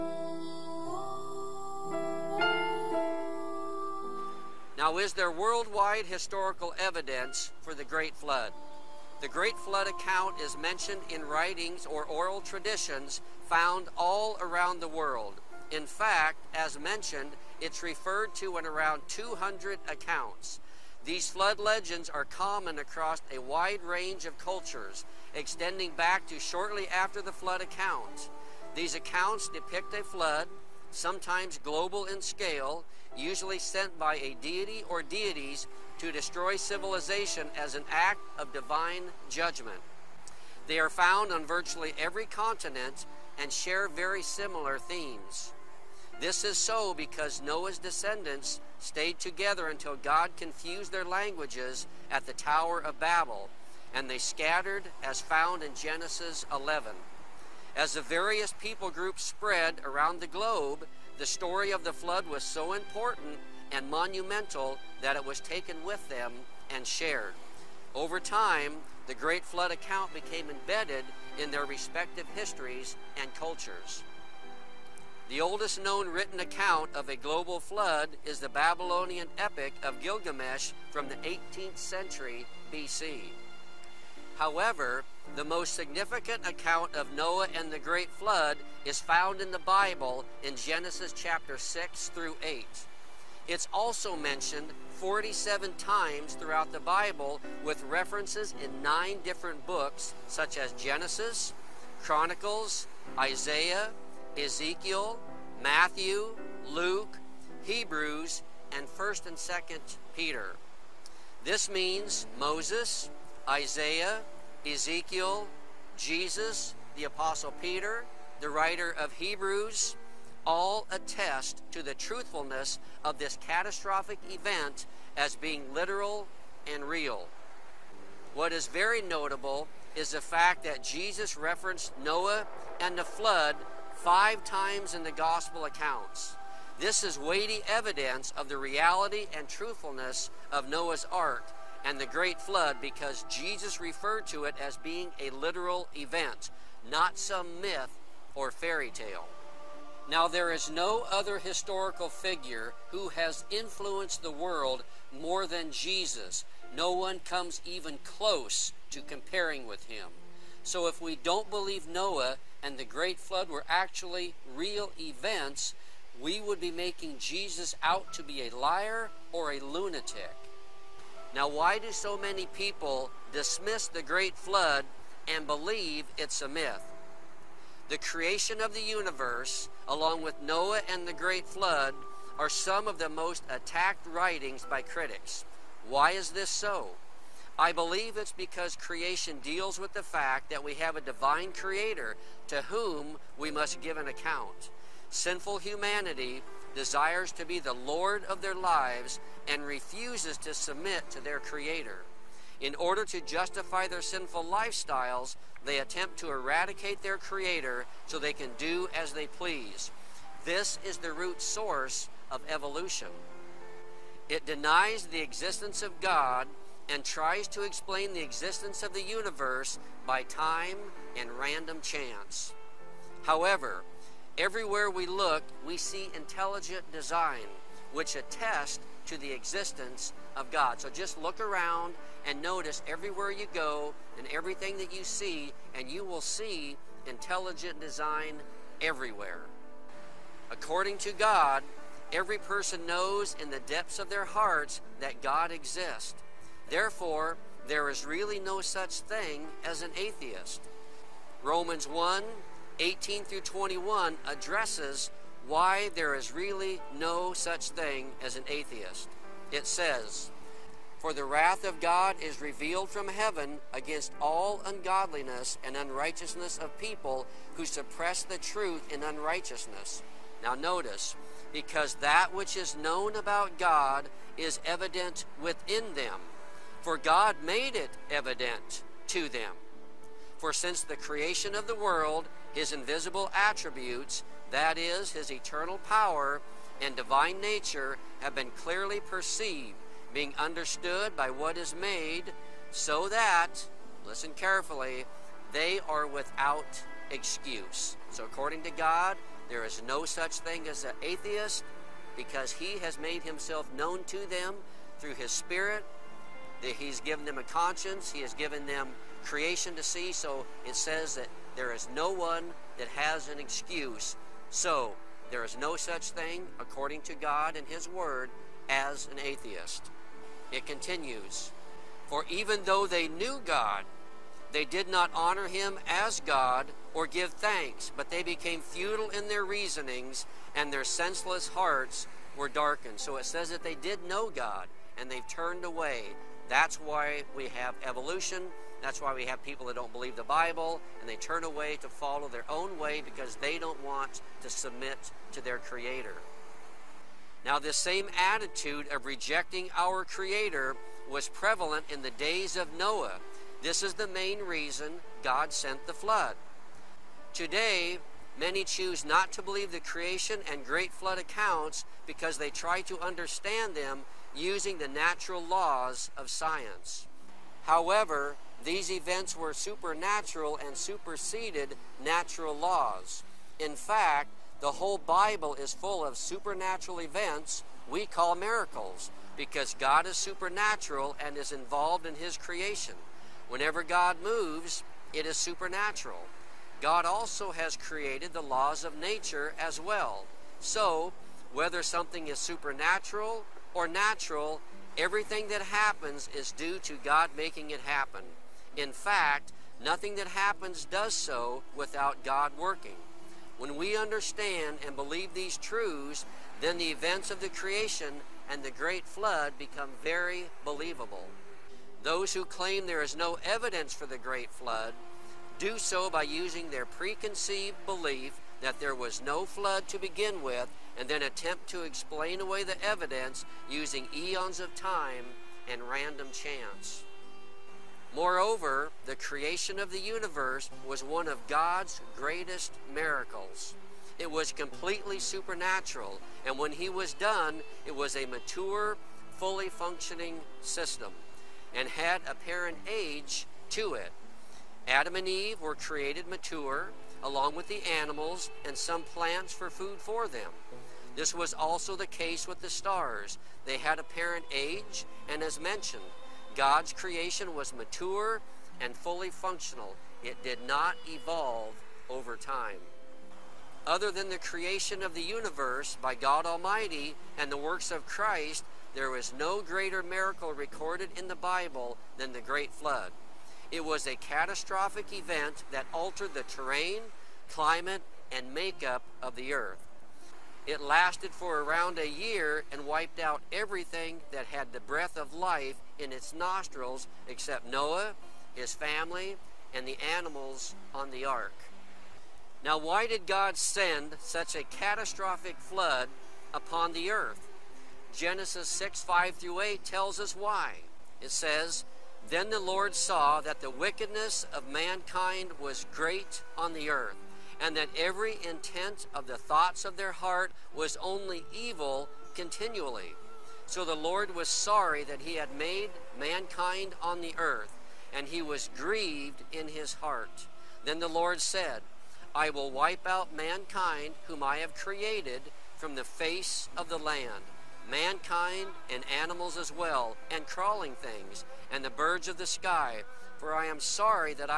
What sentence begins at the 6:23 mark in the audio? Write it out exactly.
Whenever God moves, it is supernatural.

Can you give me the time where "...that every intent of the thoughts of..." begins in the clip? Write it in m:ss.
8:27.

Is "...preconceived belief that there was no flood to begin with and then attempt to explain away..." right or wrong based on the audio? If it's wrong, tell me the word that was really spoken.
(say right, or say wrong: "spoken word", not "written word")
right.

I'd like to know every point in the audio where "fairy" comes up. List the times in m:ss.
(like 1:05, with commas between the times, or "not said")
2:28.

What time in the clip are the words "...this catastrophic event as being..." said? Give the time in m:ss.
2:03.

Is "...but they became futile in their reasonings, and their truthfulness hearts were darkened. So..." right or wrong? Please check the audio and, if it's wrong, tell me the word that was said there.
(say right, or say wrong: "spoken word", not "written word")
wrong: "senseless", not "truthfulness".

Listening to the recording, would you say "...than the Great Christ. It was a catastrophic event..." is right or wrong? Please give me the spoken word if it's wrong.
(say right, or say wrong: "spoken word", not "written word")
wrong: "Flood", not "Christ".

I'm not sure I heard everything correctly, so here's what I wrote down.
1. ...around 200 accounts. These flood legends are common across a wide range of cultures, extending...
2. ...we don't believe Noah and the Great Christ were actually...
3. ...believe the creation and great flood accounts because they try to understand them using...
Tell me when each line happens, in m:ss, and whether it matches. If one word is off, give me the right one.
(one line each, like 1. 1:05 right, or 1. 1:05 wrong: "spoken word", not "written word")
1. 0:18 right
2. 2:40 wrong: "Flood", not "Christ"
3. 5:59 right.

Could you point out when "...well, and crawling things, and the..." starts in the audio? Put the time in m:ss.
8:49.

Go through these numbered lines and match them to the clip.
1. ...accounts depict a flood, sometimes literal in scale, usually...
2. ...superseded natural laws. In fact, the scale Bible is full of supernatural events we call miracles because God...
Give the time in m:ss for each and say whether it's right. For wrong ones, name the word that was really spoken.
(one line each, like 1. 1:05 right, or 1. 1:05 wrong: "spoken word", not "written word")
1. 0:28 wrong: "global", not "literal"
2. 6:10 wrong: "whole", not "scale".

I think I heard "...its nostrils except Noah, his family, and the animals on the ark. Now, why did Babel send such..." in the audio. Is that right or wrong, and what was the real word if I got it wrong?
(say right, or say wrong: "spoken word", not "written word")
wrong: "God", not "Babel".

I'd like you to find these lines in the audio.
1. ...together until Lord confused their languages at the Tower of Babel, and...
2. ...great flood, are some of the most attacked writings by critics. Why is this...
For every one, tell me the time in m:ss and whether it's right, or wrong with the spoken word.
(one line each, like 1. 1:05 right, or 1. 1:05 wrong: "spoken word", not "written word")
1. 0:49 wrong: "God", not "Lord"
2. 3:01 right.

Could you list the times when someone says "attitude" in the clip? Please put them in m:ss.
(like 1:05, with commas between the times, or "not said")
5:48.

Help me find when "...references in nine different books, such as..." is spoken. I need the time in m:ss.
1:37.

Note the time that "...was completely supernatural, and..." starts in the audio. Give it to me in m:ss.
7:14.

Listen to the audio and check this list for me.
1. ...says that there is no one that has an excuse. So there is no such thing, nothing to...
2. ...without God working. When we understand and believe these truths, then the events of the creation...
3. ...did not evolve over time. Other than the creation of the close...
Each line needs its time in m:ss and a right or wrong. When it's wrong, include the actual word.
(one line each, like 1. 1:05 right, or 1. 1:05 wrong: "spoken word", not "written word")
1. 5:10 wrong: "according", not "nothing"
2. 6:41 right
3. 7:40 wrong: "universe", not "close".